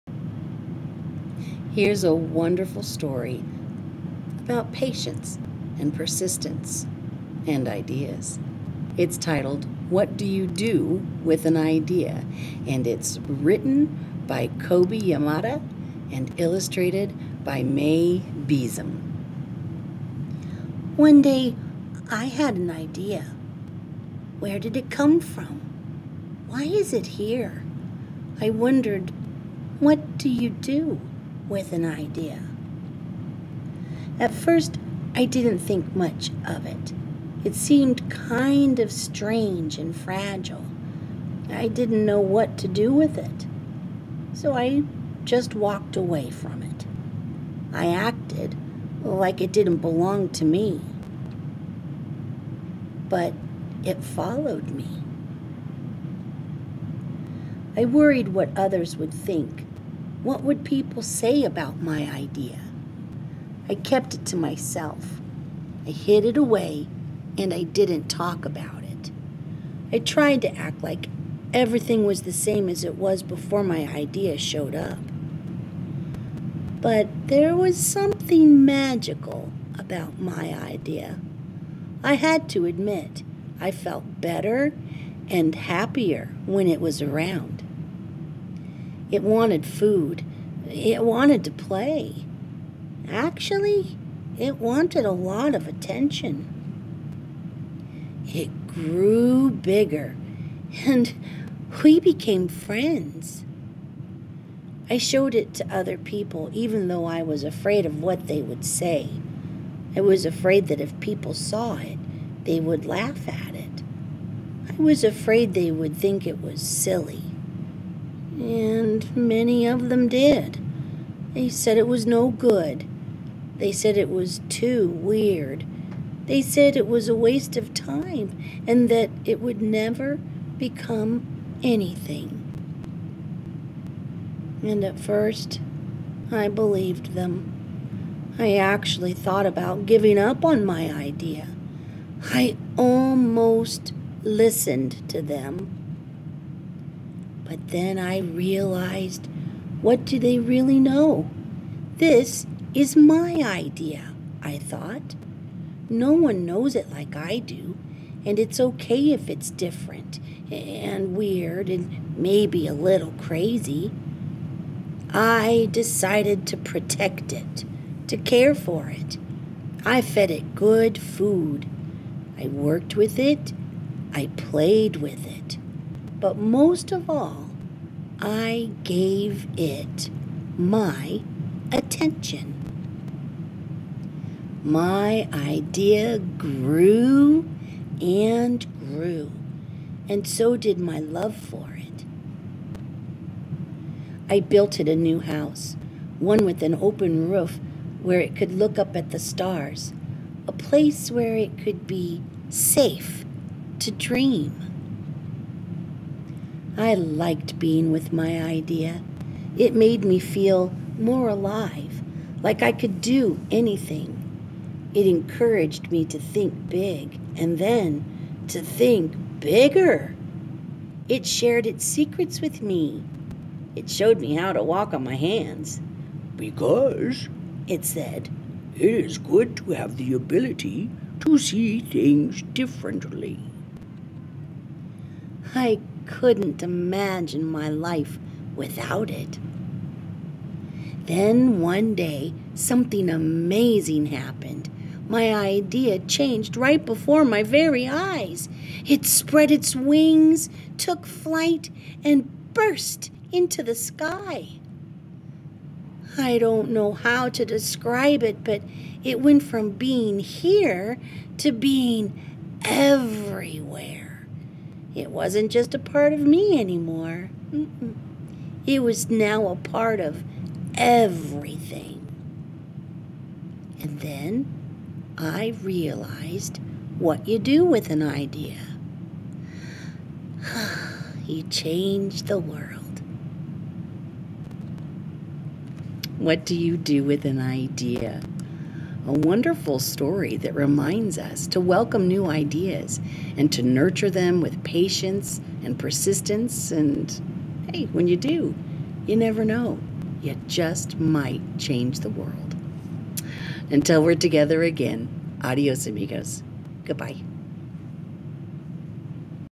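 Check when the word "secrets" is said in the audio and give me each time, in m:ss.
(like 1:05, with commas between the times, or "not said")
3:41.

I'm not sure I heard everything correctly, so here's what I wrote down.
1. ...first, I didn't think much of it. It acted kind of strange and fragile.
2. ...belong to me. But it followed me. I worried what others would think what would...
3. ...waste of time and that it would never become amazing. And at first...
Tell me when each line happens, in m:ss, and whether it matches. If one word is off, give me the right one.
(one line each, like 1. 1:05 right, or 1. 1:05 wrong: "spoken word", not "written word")
1. 0:34 wrong: "seemed", not "acted"
2. 0:49 right
3. 2:07 wrong: "anything", not "amazing".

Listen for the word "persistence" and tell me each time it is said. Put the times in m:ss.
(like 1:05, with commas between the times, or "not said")
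0:05, 4:55.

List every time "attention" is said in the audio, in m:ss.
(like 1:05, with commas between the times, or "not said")
1:35, 3:01.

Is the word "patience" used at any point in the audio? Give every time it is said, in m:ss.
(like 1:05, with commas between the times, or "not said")
0:04, 4:54.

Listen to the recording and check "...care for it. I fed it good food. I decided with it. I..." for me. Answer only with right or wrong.
wrong.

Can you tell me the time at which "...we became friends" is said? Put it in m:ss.
1:41.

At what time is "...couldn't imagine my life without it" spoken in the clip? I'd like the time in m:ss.
3:56.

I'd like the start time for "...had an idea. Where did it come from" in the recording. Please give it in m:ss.
0:22.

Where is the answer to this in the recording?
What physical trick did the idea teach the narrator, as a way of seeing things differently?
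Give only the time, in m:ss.
3:44.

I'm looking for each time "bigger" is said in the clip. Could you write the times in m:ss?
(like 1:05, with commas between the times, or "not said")
1:39, 3:39.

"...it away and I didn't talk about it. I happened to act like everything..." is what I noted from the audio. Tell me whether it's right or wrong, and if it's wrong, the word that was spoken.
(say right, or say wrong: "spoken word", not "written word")
wrong: "tried", not "happened".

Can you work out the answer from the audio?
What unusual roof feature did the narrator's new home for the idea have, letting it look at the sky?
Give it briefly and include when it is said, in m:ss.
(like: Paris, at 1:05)
An open roof, at 3:16.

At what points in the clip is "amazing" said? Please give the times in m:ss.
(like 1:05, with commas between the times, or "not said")
4:03.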